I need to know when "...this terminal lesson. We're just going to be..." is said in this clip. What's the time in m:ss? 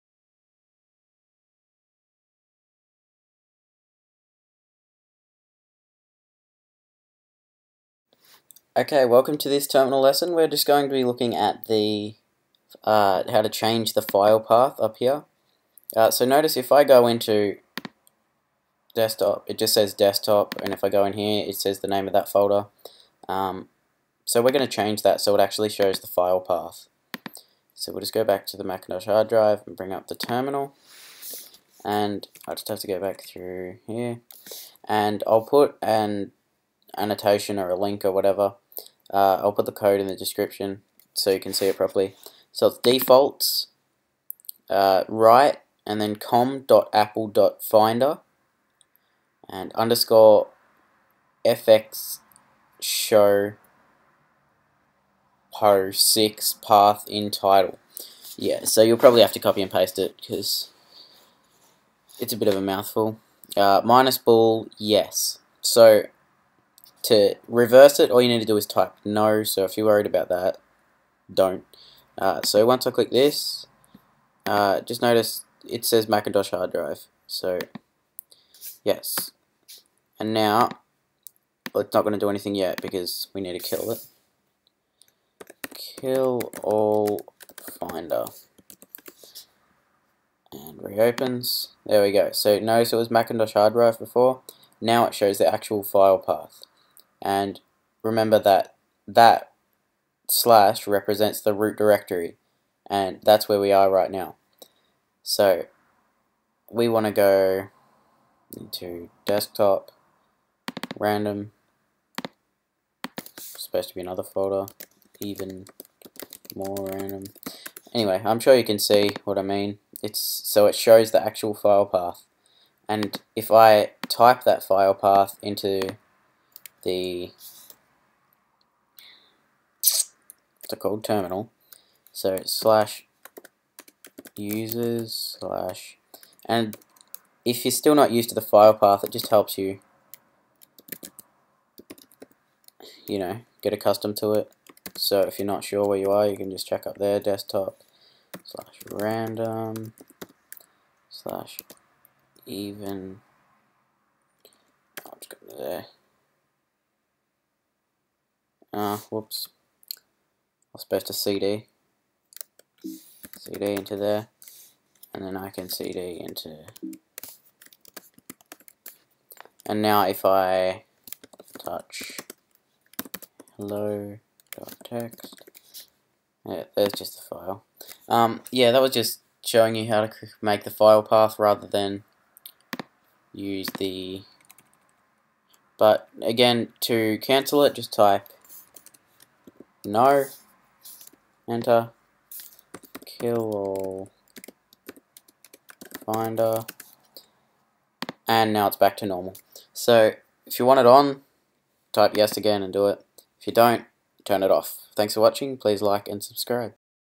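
0:09.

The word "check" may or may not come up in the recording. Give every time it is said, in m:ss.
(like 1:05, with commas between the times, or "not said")
2:26.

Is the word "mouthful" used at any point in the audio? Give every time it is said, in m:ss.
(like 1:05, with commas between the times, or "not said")
1:02.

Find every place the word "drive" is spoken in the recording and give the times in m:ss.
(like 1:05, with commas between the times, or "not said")
0:29, 1:16, 1:33.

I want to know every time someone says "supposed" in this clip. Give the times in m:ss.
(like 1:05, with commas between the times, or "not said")
1:53, 2:40.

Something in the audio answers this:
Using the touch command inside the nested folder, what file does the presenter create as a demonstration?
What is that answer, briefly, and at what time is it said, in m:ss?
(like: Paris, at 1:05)
hello text, at 2:53.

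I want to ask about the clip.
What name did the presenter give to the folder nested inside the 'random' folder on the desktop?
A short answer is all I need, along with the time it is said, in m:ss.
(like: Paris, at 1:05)
even more random, at 1:55.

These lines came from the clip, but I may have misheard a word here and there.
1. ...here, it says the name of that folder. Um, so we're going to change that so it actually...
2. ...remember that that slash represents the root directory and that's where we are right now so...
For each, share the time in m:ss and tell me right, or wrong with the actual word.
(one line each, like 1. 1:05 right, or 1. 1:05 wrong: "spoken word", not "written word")
1. 0:21 right
2. 1:38 right.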